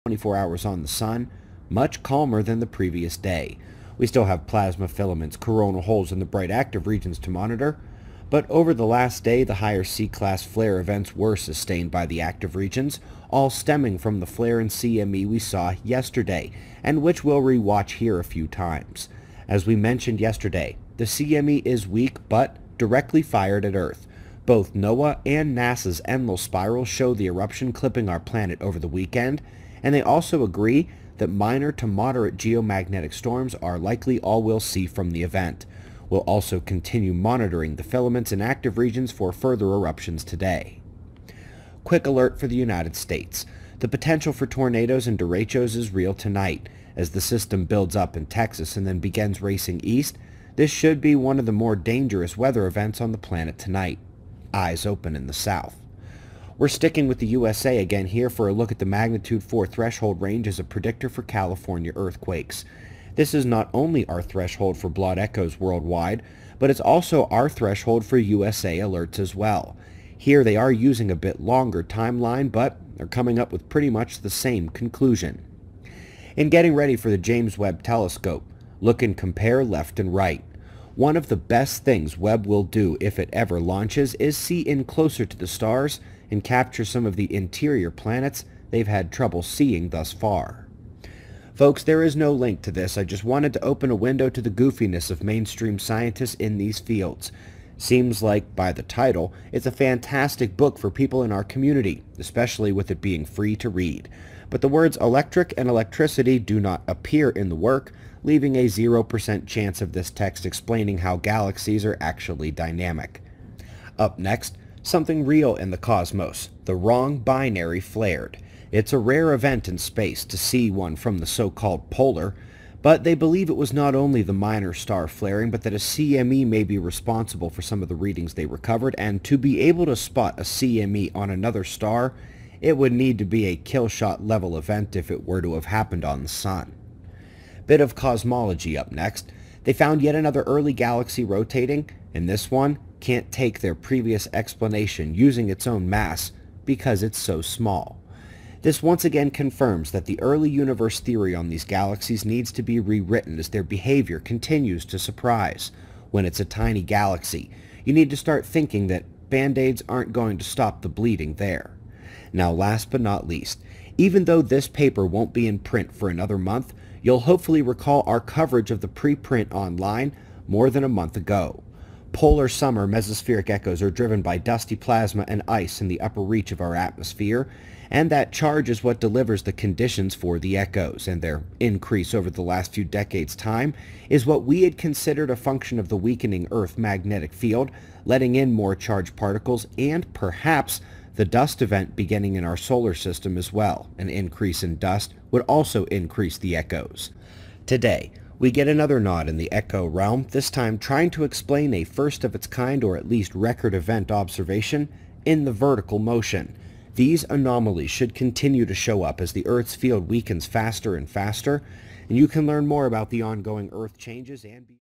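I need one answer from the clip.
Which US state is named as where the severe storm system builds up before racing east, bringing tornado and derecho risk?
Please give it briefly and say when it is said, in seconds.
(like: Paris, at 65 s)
Texas, at 48 s.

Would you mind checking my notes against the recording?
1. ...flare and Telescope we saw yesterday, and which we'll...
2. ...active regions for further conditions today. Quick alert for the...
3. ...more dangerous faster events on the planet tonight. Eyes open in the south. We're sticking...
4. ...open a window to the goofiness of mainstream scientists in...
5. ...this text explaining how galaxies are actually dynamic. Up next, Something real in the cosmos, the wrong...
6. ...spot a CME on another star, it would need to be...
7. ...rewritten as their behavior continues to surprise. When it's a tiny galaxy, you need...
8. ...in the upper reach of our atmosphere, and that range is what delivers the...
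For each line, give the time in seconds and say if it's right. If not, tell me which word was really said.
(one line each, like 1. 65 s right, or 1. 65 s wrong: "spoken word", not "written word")
1. 14 s wrong: "CME", not "Telescope"
2. 38 s wrong: "eruptions", not "conditions"
3. 51 s wrong: "weather", not "faster"
4. 93 s right
5. 109 s right
6. 129 s right
7. 152 s right
8. 175 s wrong: "charge", not "range".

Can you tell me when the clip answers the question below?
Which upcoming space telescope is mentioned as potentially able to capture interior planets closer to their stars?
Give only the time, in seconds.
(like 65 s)
77 s.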